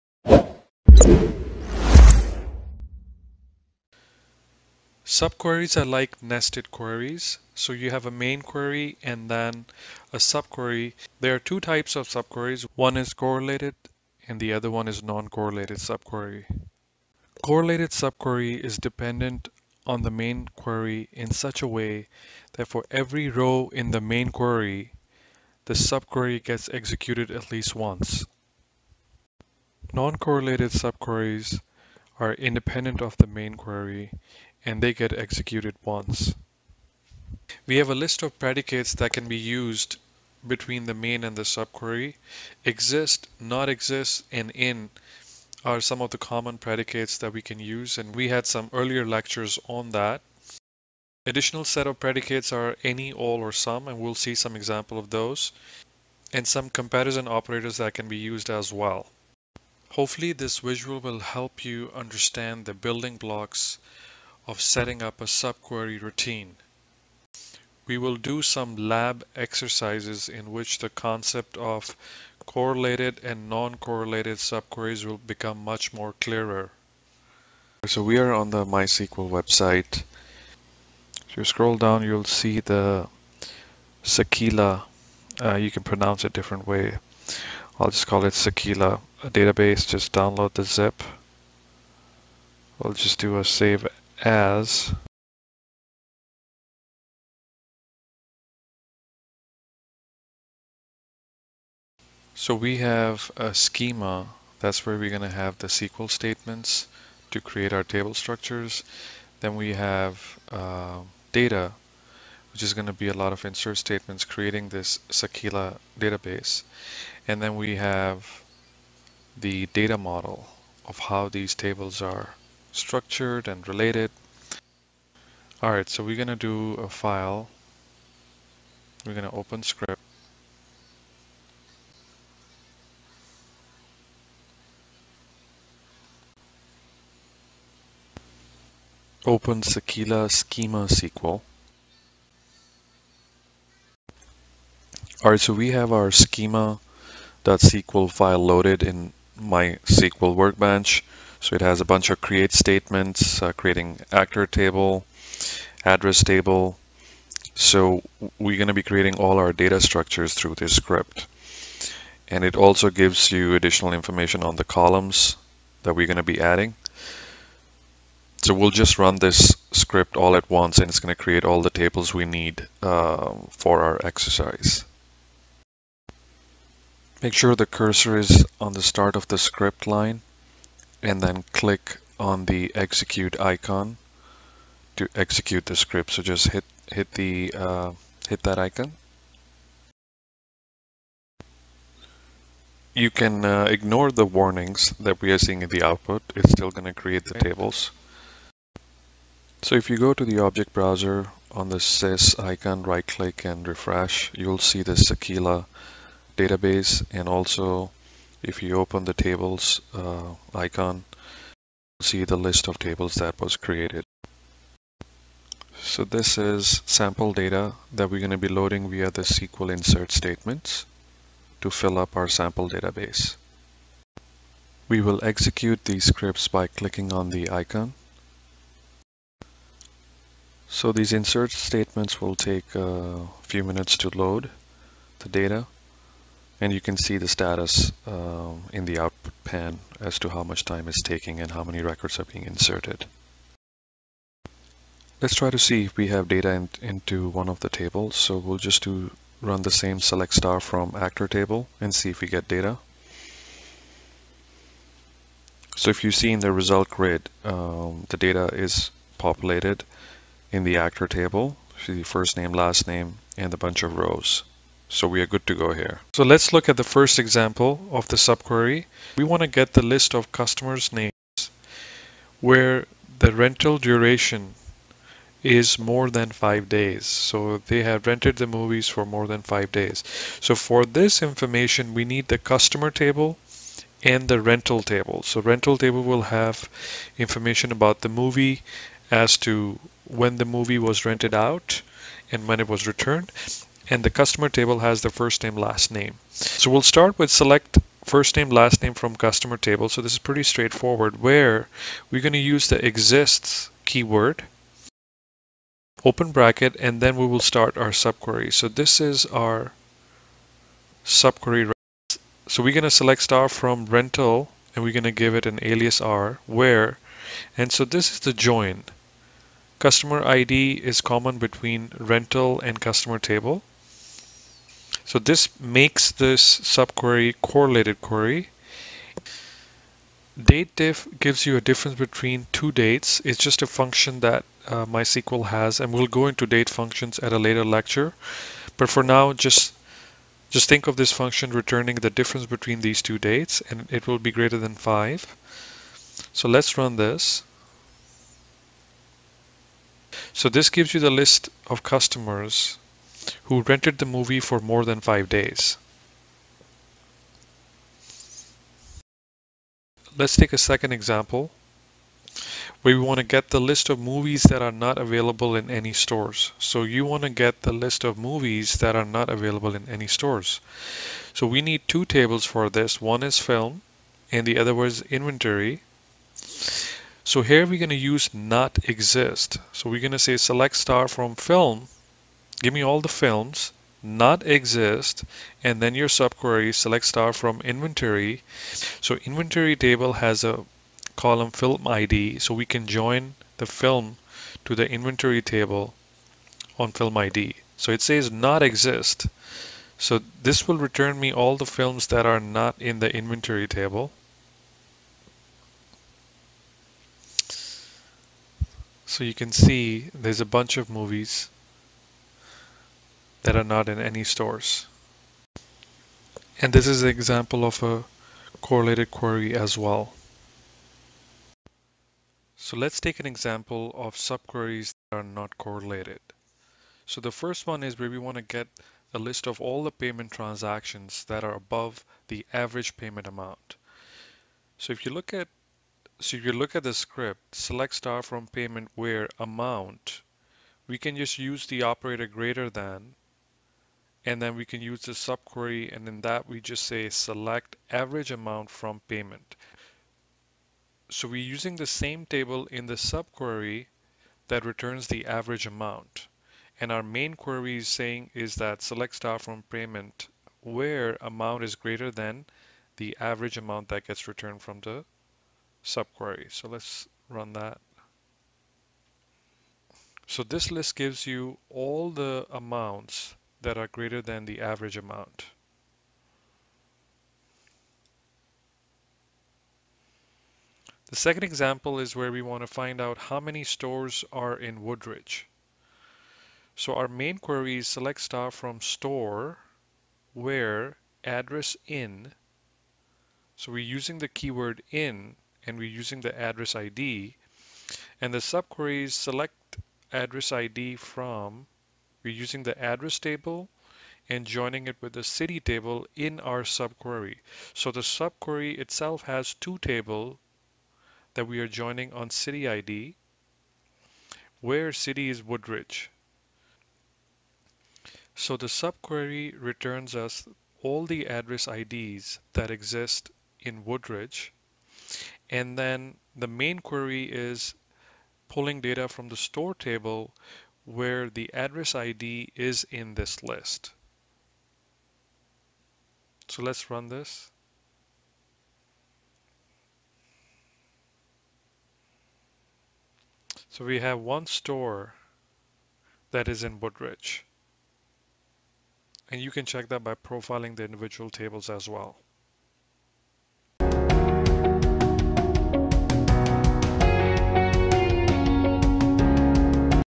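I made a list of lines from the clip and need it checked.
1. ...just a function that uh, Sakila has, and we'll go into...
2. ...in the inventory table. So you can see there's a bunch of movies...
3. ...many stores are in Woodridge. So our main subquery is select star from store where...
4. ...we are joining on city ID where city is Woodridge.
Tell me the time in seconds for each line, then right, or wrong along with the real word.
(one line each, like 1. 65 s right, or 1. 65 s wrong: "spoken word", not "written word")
1. 333 s wrong: "MySQL", not "Sakila"
2. 402 s right
3. 483 s wrong: "query", not "subquery"
4. 511 s right.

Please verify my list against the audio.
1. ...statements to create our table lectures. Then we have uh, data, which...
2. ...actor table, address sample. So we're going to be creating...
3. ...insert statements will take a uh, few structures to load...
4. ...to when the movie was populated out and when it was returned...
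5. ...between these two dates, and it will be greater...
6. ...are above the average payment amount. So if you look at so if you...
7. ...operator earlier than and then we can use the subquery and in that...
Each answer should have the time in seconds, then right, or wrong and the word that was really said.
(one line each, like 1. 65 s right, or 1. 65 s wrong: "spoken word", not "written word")
1. 106 s wrong: "structures", not "lectures"
2. 154 s wrong: "table", not "sample"
3. 231 s wrong: "minutes", not "structures"
4. 289 s wrong: "rented", not "populated"
5. 342 s right
6. 431 s right
7. 441 s wrong: "greater", not "earlier".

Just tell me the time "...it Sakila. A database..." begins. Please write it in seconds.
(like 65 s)
88 s.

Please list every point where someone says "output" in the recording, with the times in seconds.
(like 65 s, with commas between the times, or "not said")
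195 s, 238 s.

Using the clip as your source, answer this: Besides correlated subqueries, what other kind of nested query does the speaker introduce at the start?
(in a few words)
Non-correlated subquery.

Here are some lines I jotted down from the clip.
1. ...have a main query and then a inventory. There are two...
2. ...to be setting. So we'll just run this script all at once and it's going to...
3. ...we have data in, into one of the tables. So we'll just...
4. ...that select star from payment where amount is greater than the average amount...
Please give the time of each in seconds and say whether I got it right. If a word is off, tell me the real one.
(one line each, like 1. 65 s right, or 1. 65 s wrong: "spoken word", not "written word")
1. 7 s wrong: "subquery", not "inventory"
2. 166 s wrong: "adding", not "setting"
3. 245 s right
4. 458 s right.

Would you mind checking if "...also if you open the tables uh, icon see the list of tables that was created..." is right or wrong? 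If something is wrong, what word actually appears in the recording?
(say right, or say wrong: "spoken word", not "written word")
right.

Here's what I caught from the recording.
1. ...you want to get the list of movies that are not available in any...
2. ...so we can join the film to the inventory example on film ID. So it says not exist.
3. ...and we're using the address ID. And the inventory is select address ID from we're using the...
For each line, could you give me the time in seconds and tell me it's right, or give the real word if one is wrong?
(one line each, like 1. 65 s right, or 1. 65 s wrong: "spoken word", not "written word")
1. 366 s right
2. 392 s wrong: "table", not "example"
3. 495 s wrong: "subquery", not "inventory".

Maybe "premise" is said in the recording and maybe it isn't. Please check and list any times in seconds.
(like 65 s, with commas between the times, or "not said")
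not said.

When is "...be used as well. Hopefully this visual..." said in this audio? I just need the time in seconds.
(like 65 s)
58 s.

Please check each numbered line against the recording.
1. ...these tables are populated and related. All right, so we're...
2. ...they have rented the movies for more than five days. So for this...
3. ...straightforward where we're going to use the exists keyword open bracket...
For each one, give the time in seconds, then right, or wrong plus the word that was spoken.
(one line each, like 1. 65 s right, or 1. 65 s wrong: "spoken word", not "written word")
1. 121 s wrong: "structured", not "populated"
2. 277 s right
3. 300 s right.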